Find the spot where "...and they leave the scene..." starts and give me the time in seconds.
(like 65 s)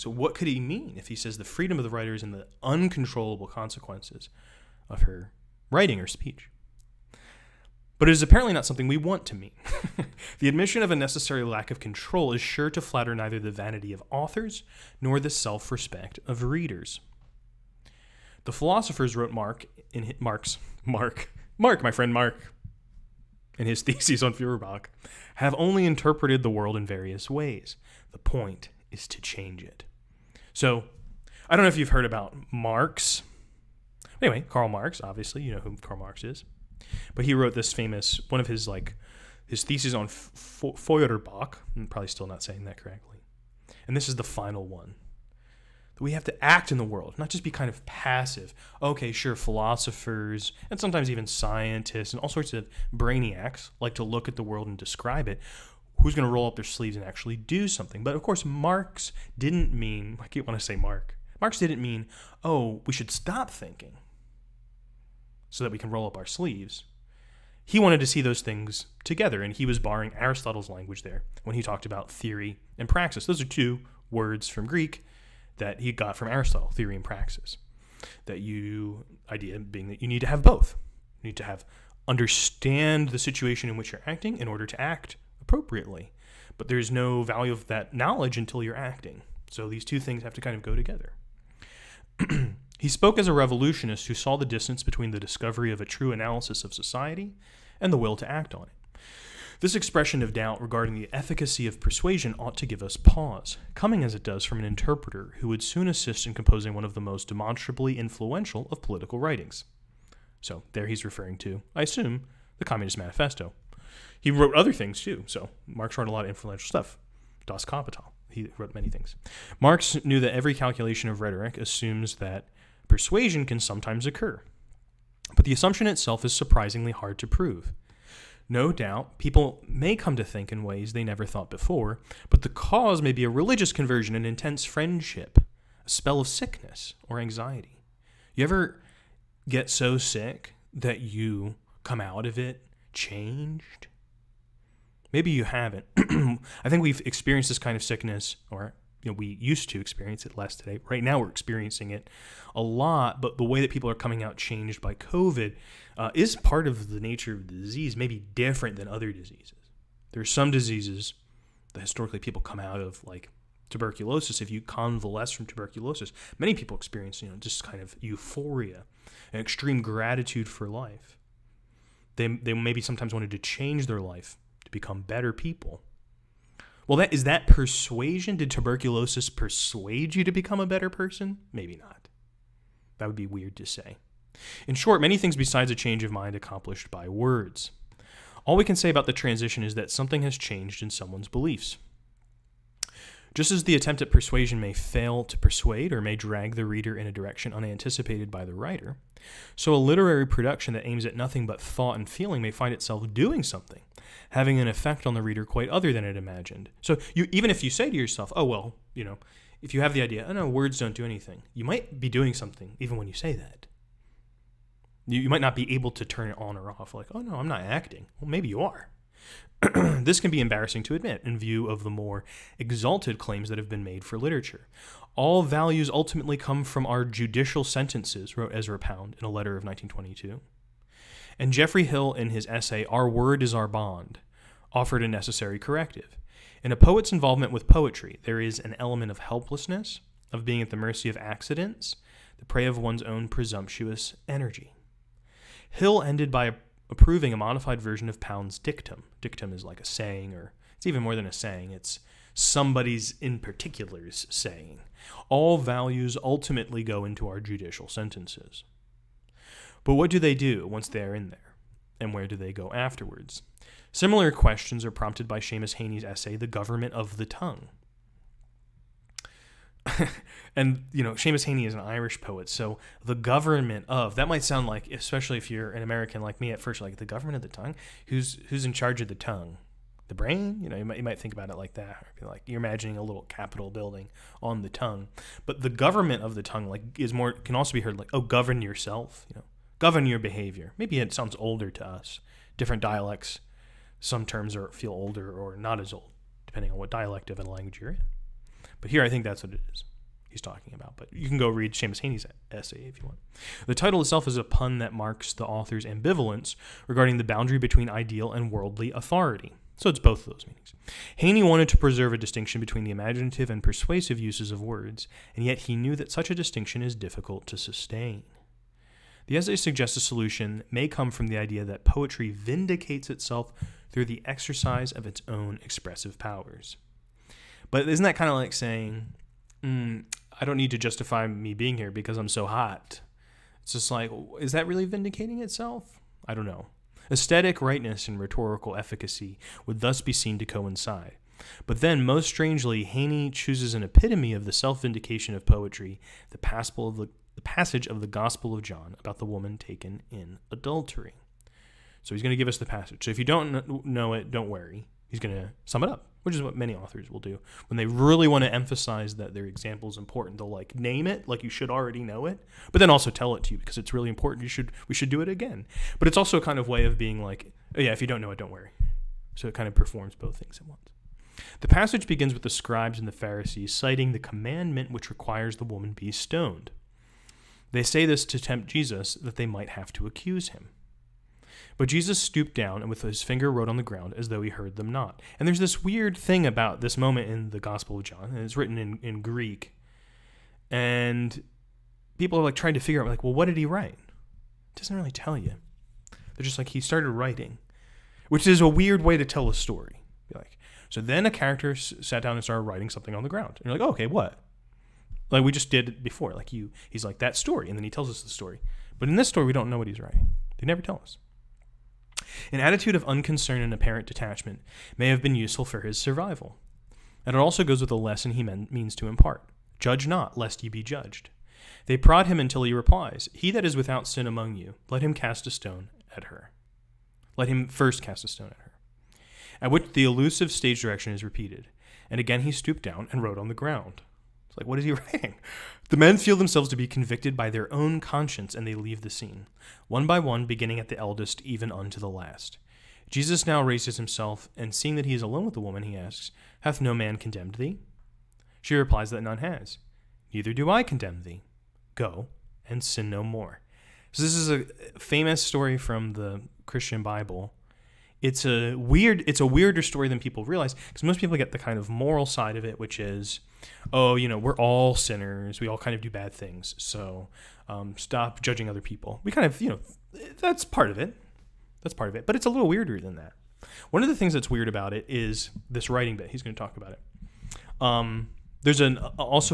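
438 s.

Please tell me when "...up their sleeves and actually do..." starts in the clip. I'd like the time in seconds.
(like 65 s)
56 s.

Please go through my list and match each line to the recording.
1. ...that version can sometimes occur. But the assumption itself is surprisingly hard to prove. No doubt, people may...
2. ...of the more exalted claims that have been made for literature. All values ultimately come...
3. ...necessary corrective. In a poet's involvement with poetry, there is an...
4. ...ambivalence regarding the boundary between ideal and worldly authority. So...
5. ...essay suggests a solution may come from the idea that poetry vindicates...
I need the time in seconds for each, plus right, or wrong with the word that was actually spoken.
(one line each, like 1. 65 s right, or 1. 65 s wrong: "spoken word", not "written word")
1. 122 s wrong: "persuasion", not "version"
2. 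221 s right
3. 235 s right
4. 305 s right
5. 319 s right.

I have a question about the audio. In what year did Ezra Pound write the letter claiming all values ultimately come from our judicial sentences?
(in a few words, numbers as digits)
1922.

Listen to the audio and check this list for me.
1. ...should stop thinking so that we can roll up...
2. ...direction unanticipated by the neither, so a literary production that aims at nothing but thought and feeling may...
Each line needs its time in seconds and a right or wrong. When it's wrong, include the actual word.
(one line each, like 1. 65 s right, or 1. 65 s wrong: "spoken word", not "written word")
1. 62 s right
2. 197 s wrong: "writer", not "neither".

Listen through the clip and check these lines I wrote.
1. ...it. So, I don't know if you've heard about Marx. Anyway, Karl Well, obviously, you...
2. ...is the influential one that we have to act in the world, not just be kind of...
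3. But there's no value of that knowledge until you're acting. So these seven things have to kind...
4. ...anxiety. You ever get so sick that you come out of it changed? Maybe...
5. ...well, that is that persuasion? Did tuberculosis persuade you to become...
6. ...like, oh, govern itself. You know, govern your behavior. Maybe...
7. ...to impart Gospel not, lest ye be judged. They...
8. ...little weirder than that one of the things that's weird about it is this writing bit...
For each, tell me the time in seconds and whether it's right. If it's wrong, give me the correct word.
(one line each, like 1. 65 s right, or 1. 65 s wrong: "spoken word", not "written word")
1. 29 s wrong: "Marx", not "Well"
2. 44 s wrong: "final", not "influential"
3. 86 s wrong: "two", not "seven"
4. 137 s right
5. 176 s right
6. 287 s wrong: "yourself", not "itself"
7. 418 s wrong: "Judge", not "Gospel"
8. 472 s right.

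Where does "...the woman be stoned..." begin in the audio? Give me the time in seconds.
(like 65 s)
375 s.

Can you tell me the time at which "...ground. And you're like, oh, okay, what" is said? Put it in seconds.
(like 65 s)
403 s.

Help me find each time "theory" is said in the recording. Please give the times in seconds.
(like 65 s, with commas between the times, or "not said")
72 s, 76 s.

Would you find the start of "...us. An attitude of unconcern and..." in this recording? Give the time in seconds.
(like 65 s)
411 s.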